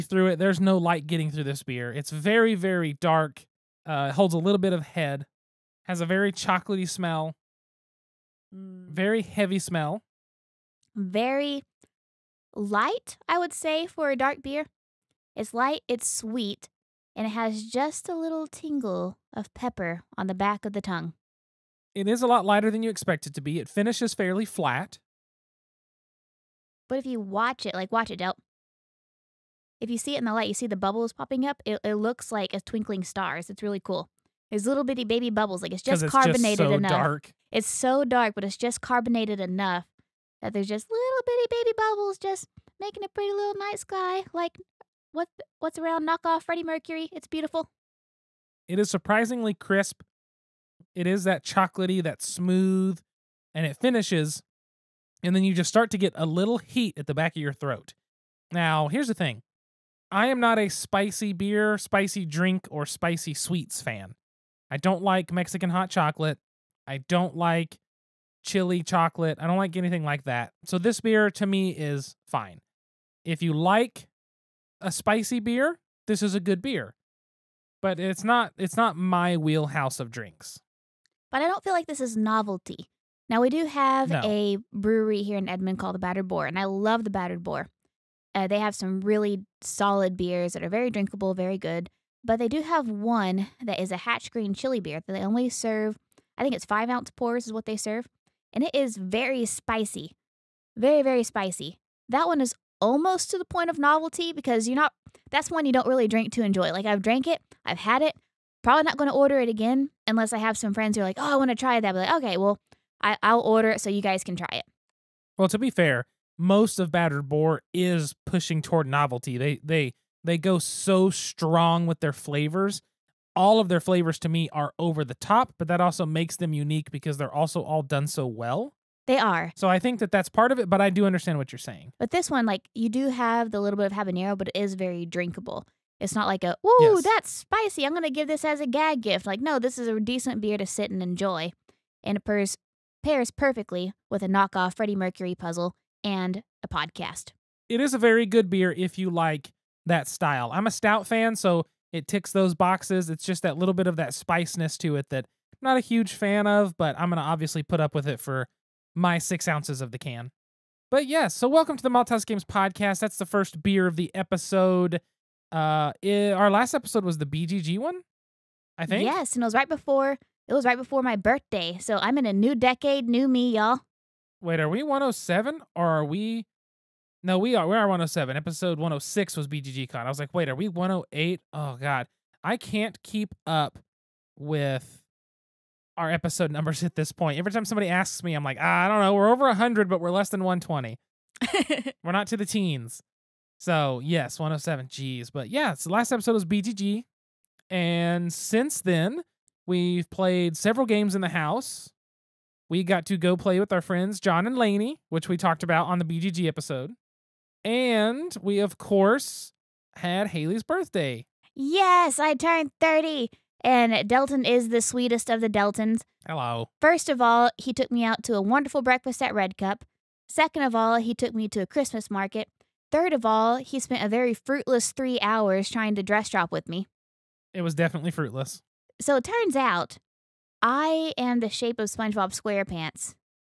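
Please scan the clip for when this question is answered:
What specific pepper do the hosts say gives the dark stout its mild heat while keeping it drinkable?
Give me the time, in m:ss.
2:13.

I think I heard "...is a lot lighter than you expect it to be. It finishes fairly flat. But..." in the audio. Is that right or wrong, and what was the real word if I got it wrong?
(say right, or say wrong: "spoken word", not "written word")
right.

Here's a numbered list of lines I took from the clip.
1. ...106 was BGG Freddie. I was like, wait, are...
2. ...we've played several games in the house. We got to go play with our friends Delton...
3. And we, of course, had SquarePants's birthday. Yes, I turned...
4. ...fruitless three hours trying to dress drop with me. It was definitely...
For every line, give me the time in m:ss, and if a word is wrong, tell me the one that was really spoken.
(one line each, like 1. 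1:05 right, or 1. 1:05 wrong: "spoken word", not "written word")
1. 2:58 wrong: "Con", not "Freddie"
2. 3:19 wrong: "John", not "Delton"
3. 3:27 wrong: "Haley", not "SquarePants"
4. 3:44 right.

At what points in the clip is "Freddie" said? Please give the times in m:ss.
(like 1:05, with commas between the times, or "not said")
0:46, 2:24.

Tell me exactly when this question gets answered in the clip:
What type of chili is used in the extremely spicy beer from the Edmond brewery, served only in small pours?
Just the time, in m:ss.
1:33.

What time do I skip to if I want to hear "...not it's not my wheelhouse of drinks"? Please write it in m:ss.
1:18.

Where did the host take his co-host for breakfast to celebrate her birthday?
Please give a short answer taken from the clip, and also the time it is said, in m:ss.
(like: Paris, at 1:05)
Red Cup, at 3:39.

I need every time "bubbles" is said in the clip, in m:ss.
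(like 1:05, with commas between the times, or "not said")
0:30, 0:35, 0:41.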